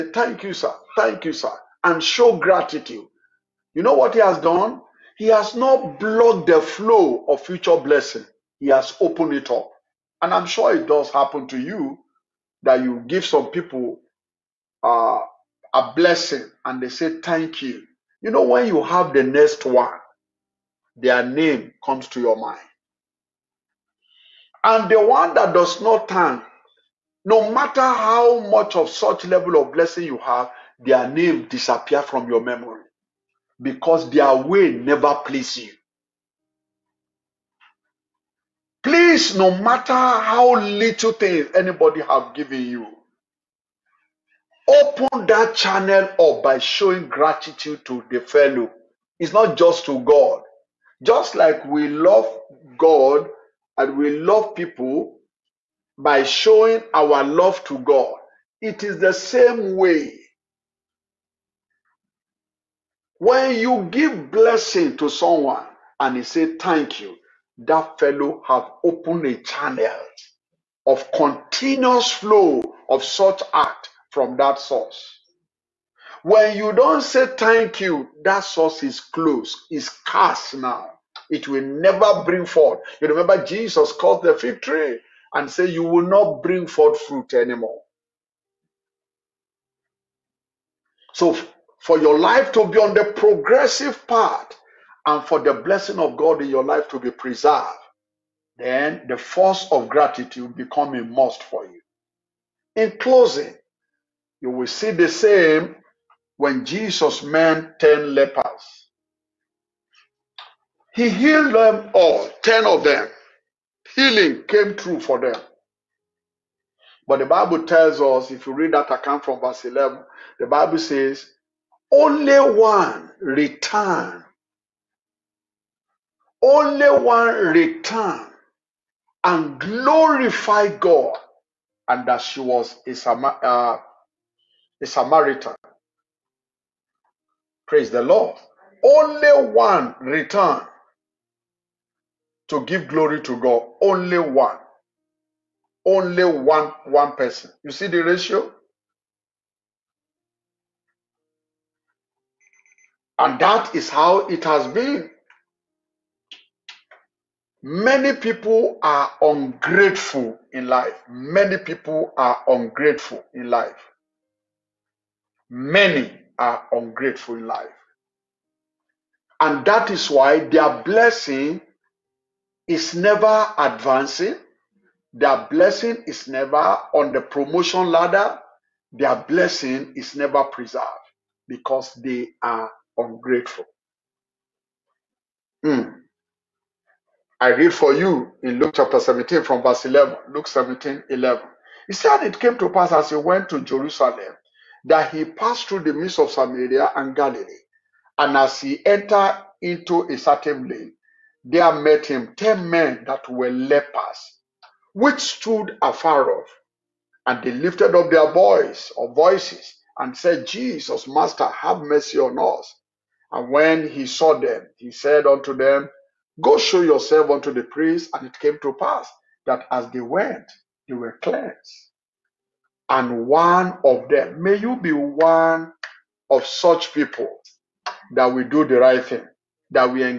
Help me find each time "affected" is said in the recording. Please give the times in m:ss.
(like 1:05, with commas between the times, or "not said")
not said.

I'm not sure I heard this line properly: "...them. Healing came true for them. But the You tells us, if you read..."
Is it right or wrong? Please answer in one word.
wrong.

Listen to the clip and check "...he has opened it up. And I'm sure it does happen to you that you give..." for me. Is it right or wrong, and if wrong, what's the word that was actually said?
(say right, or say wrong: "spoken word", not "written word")
right.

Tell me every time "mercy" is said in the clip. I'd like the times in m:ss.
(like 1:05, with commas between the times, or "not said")
3:31.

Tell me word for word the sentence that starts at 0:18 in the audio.
You know, when you have the next one, their name comes to your mind.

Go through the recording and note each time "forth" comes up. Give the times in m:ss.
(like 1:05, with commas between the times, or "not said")
1:22, 1:26.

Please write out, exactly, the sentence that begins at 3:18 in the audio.
And as he entered into a certain lane, there met him ten men that were lepers, which stood afar off.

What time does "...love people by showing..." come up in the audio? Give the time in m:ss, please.
0:54.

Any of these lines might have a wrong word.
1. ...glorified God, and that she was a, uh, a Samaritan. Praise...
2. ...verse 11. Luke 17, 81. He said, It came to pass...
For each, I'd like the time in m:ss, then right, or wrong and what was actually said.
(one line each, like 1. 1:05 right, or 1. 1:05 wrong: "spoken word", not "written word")
1. 2:09 right
2. 3:09 wrong: "11", not "81".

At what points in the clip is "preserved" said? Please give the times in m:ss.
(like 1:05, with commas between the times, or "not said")
1:37, 3:00.